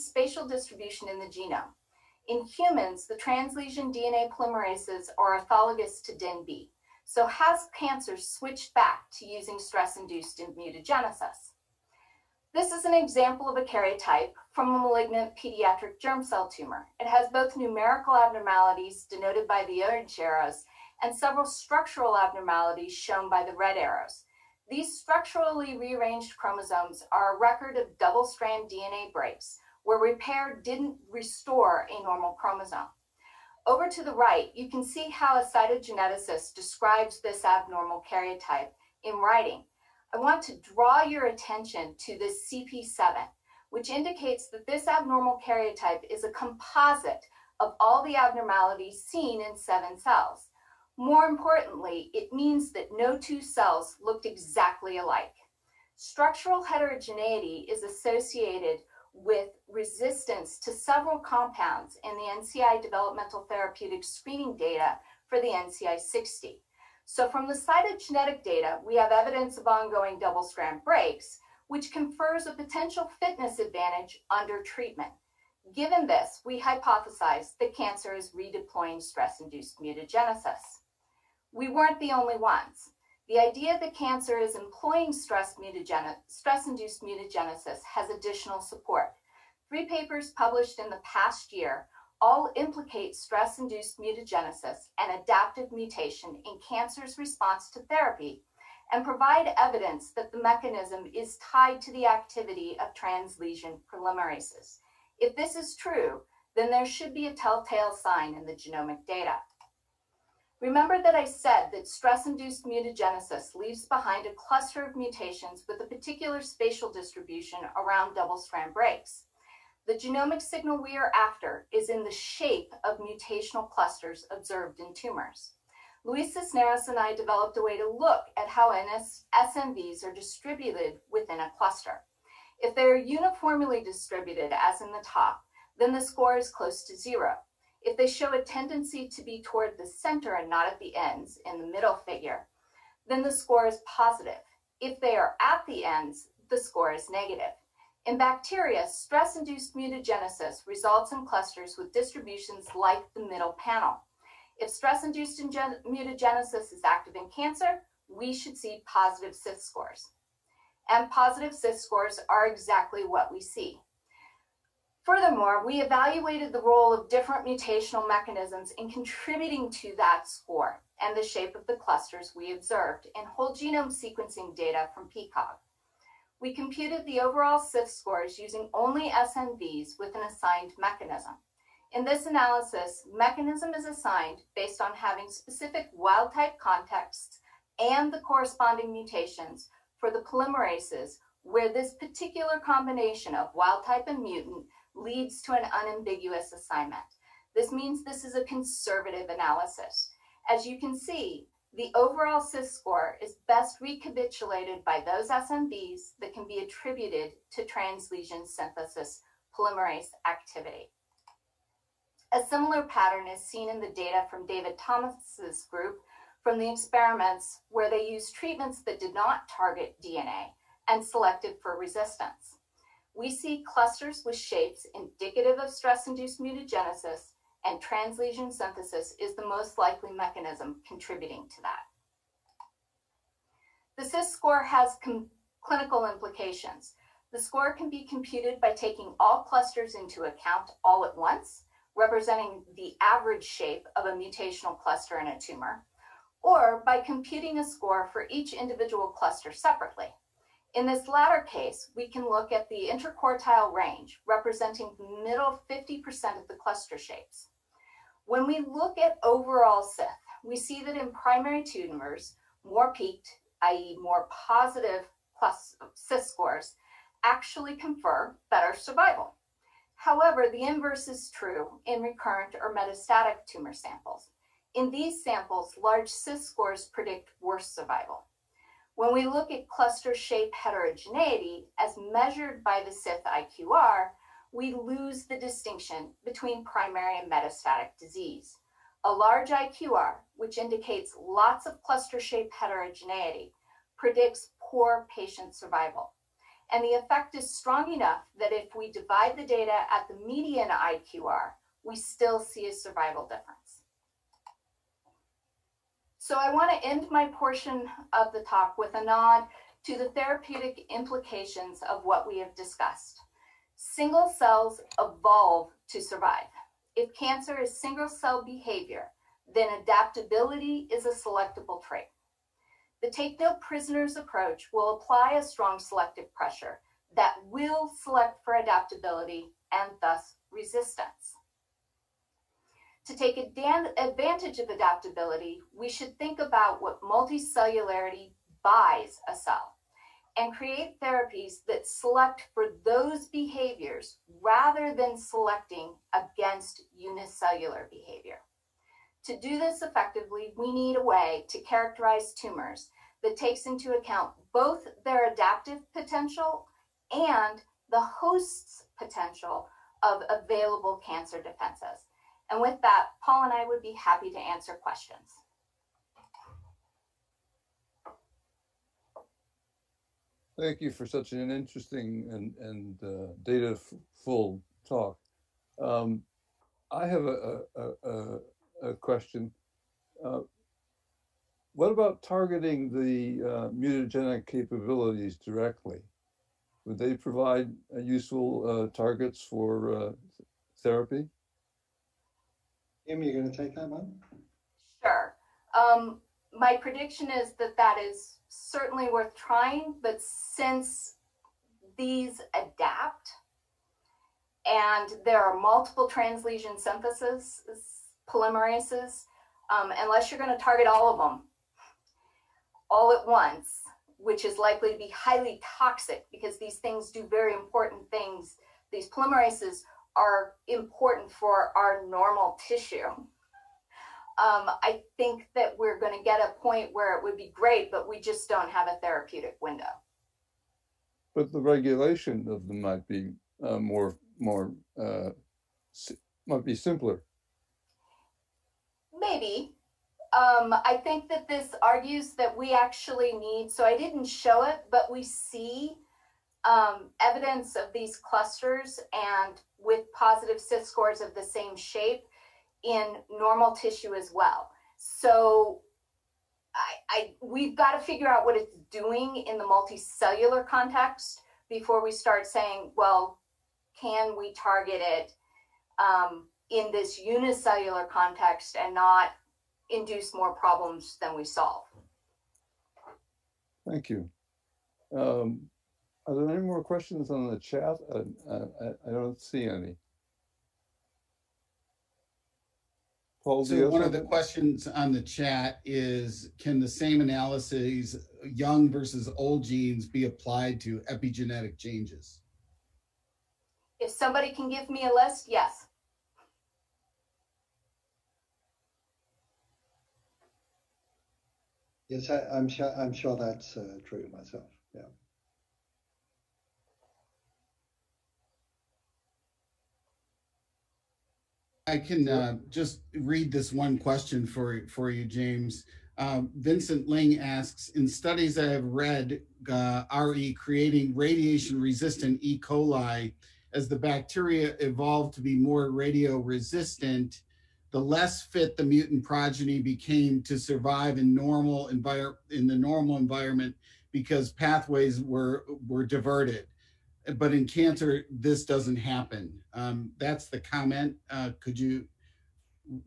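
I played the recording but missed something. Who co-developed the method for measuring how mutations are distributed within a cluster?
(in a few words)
Luis Cisneros.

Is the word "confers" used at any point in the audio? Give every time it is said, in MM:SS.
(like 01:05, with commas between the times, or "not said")
01:11, 04:27.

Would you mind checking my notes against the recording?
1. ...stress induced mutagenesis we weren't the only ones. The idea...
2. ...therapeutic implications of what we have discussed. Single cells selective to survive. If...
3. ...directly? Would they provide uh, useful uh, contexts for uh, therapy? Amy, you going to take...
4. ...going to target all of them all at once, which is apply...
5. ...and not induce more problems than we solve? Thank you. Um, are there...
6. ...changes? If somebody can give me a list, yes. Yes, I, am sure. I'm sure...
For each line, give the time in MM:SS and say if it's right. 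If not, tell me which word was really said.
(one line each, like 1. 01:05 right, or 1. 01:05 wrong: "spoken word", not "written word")
1. 01:19 right
2. 05:10 wrong: "evolve", not "selective"
3. 06:25 wrong: "targets", not "contexts"
4. 06:50 wrong: "likely", not "apply"
5. 07:48 right
6. 08:11 right.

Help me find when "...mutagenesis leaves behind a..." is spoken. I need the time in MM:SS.
01:52.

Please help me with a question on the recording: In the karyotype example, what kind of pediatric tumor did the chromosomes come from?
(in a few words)
Malignant pediatric germ cell tumor.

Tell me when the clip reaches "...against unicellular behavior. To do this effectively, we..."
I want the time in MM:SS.
05:46.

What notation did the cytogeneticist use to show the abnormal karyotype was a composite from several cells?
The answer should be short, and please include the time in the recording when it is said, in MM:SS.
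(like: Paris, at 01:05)
CP7, at 00:42.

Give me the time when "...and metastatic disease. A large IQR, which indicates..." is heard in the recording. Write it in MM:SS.
04:47.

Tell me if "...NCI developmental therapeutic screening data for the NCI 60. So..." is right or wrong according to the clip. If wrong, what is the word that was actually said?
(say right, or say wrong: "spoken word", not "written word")
right.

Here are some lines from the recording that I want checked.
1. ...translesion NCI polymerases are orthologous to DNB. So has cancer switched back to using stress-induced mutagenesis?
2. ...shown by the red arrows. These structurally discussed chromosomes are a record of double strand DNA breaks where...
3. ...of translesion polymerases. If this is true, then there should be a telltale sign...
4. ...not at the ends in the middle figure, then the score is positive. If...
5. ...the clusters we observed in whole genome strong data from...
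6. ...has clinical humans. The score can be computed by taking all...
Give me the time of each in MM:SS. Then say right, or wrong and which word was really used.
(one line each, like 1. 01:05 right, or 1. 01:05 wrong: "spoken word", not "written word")
1. 00:03 wrong: "DNA", not "NCI"
2. 00:22 wrong: "rearranged", not "discussed"
3. 01:42 right
4. 02:20 right
5. 02:51 wrong: "sequencing", not "strong"
6. 03:54 wrong: "implications", not "humans".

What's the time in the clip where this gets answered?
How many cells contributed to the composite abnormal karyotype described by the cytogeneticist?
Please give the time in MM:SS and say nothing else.
00:49.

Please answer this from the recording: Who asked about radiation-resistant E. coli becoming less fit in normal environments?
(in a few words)
Vincent Ling.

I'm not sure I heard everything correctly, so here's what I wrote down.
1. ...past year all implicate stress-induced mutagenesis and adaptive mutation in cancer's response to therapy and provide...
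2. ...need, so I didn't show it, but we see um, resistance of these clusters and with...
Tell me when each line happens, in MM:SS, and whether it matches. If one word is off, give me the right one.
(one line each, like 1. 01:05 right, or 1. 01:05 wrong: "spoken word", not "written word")
1. 01:31 right
2. 07:23 wrong: "evidence", not "resistance".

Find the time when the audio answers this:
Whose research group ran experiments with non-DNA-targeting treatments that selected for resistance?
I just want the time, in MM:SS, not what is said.
03:34.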